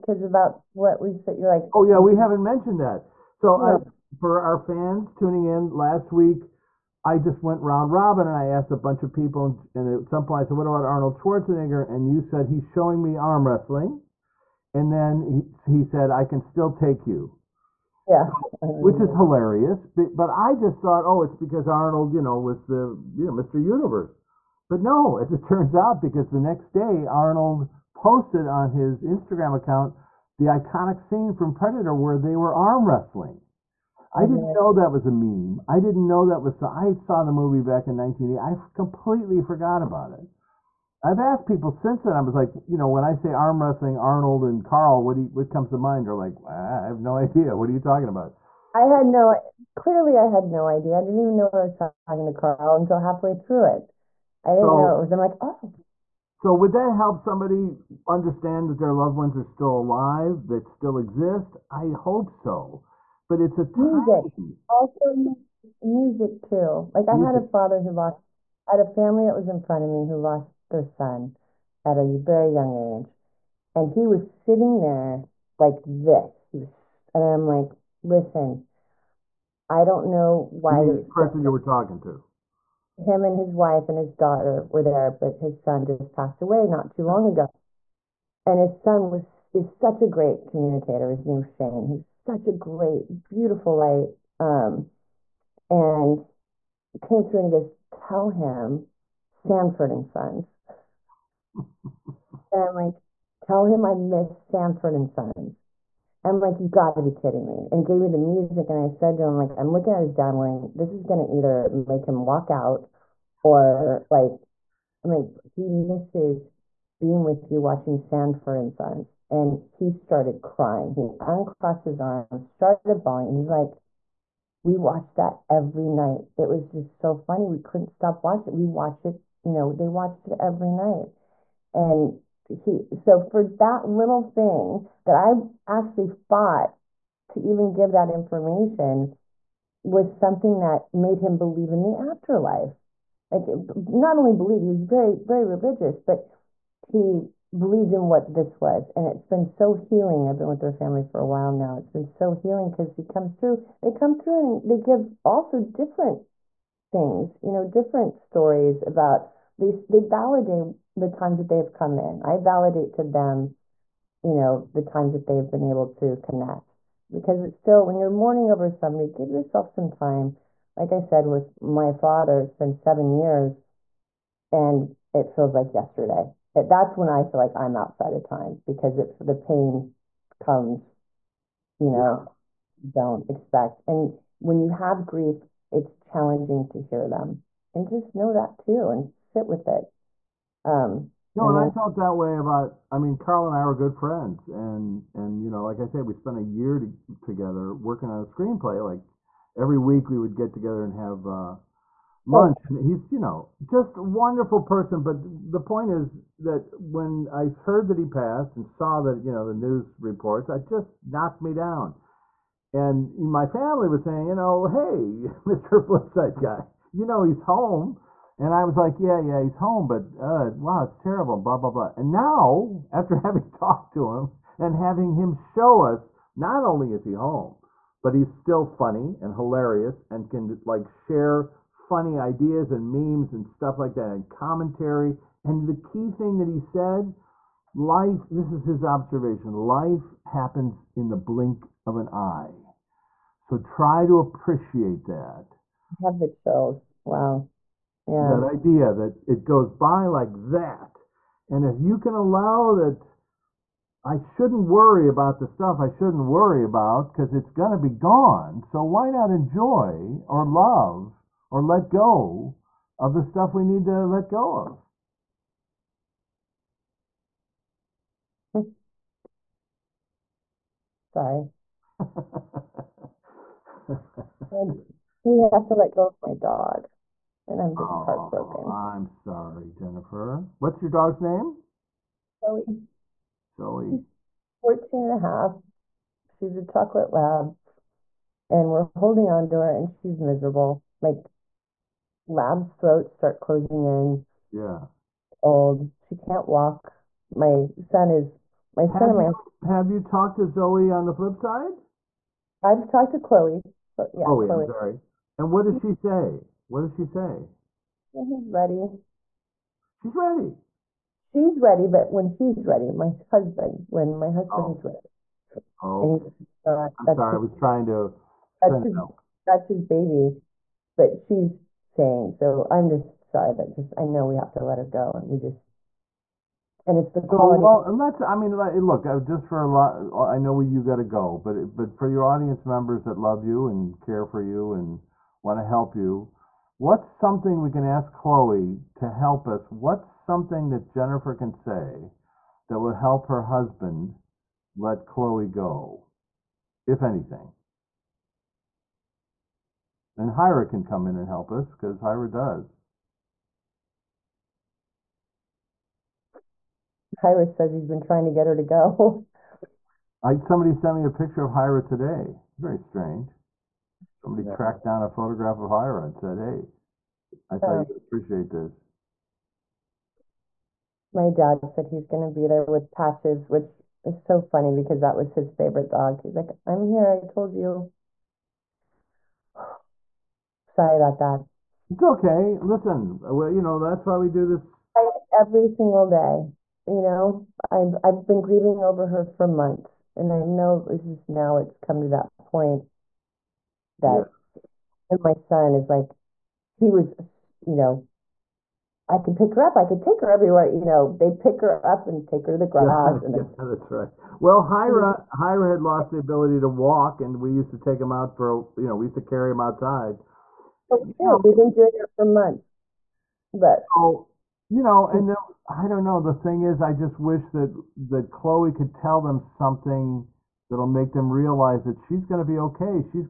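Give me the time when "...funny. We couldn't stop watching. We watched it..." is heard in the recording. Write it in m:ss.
2:07.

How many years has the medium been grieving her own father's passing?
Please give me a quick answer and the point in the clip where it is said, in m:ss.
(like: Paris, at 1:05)
7, at 2:52.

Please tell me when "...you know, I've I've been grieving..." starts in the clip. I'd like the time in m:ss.
6:26.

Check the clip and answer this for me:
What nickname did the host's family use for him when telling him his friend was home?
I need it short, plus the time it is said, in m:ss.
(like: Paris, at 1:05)
Mr. Flipside Guy, at 3:35.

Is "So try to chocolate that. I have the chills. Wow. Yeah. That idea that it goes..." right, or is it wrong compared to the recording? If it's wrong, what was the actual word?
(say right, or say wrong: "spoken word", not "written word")
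wrong: "appreciate", not "chocolate".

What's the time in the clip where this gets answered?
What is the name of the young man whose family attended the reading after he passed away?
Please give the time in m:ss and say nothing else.
1:31.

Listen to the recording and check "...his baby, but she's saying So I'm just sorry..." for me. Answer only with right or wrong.
right.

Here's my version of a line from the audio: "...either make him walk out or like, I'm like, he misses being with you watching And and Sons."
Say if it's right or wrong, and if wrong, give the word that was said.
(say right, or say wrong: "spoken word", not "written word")
wrong: "Sanford", not "And".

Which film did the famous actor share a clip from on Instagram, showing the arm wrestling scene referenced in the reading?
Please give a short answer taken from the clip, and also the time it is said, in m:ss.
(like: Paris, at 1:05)
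Predator, at 0:31.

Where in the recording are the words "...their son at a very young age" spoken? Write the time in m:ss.
1:10.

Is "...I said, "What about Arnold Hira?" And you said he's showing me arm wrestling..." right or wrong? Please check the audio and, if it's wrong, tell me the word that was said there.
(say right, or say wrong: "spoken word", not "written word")
wrong: "Schwarzenegger", not "Hira".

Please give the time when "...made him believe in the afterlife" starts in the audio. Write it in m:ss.
2:20.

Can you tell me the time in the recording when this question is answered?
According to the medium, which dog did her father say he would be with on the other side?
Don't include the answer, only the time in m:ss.
6:12.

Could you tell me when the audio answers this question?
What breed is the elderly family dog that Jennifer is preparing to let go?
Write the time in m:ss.
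4:46.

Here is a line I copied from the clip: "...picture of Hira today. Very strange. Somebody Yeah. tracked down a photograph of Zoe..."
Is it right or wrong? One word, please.
wrong.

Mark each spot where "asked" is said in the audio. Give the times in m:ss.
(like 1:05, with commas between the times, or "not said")
0:08, 0:41.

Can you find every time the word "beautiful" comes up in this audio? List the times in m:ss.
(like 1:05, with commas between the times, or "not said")
1:33.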